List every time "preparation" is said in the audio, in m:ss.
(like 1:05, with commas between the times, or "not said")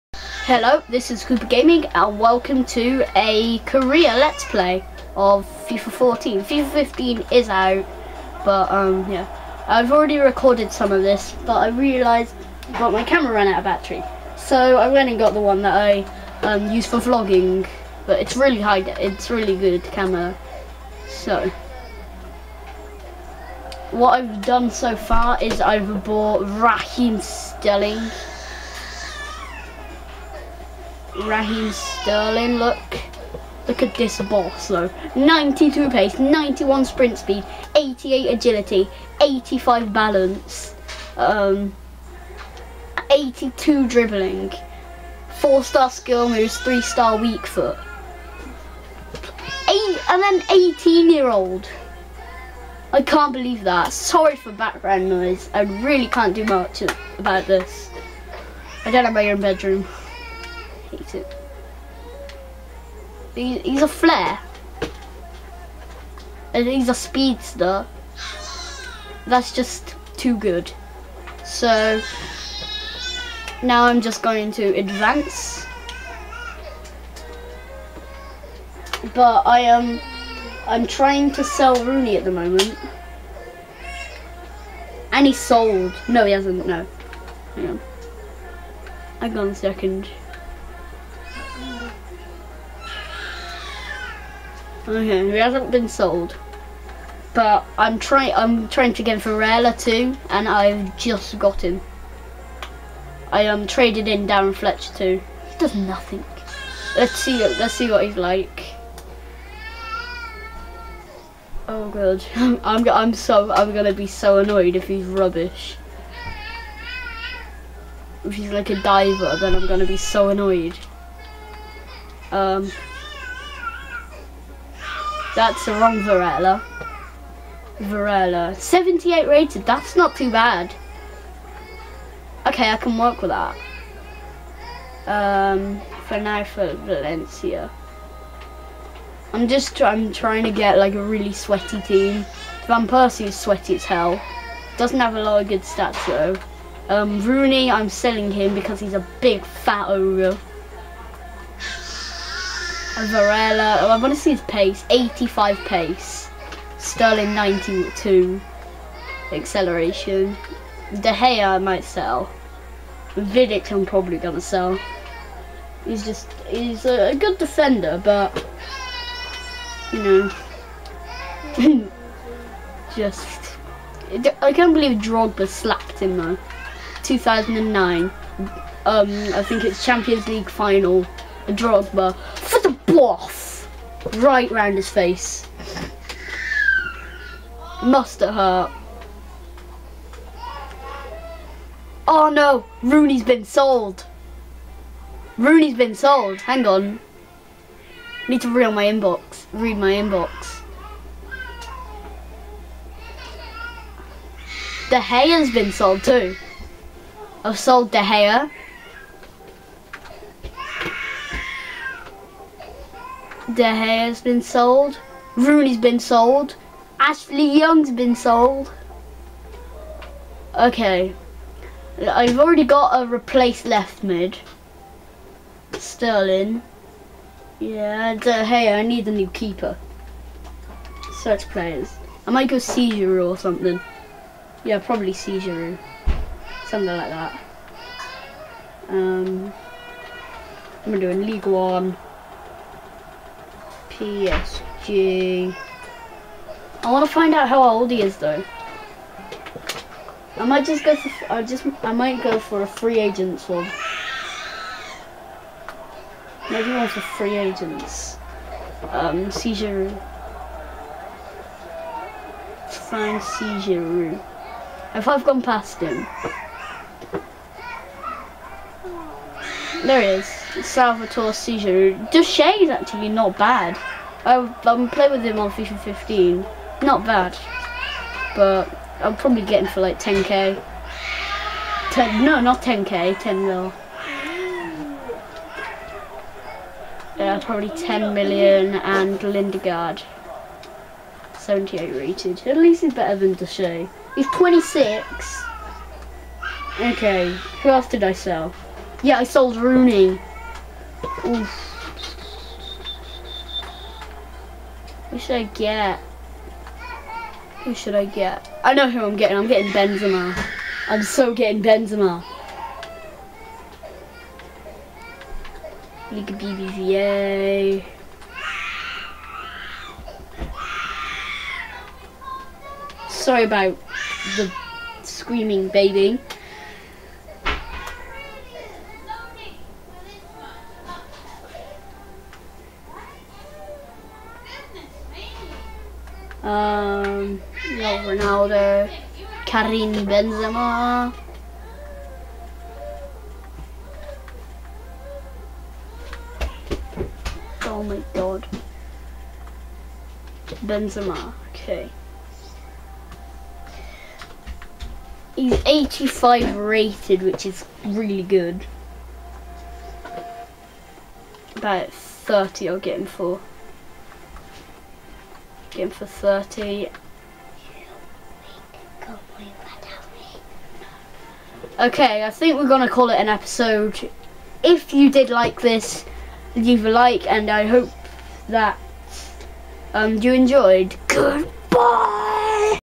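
not said.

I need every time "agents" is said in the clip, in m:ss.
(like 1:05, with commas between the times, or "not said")
4:12, 4:17.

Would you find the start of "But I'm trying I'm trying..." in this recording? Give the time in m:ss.
1:37.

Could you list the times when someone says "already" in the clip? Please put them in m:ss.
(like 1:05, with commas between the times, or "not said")
0:09, 3:42.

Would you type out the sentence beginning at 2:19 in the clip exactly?
I'm just I'm trying to get like a really sweaty team.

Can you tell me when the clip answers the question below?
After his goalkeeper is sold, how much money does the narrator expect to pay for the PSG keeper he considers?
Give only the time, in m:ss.
4:47.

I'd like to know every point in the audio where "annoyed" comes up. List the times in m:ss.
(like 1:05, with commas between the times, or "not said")
1:54, 2:00.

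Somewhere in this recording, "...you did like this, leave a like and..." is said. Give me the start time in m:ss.
6:14.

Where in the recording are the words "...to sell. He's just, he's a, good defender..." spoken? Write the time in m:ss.
2:44.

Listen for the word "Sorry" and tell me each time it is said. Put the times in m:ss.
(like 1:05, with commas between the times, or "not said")
0:53, 5:23.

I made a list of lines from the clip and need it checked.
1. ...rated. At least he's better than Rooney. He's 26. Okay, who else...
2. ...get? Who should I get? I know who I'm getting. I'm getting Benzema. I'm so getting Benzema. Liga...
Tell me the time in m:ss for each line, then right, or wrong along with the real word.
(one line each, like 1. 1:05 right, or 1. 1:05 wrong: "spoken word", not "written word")
1. 4:51 wrong: "Duchesne", not "Rooney"
2. 5:05 right.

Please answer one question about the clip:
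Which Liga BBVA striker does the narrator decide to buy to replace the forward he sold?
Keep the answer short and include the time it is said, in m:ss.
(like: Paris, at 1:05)
Karim Benzema, at 5:39.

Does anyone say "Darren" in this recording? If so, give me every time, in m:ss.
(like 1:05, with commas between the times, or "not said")
1:44.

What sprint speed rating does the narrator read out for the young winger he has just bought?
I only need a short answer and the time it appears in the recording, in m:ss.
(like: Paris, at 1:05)
91, at 0:36.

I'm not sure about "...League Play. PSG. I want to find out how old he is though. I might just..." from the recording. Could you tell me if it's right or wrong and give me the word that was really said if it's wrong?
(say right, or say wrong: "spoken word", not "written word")
wrong: "One", not "Play".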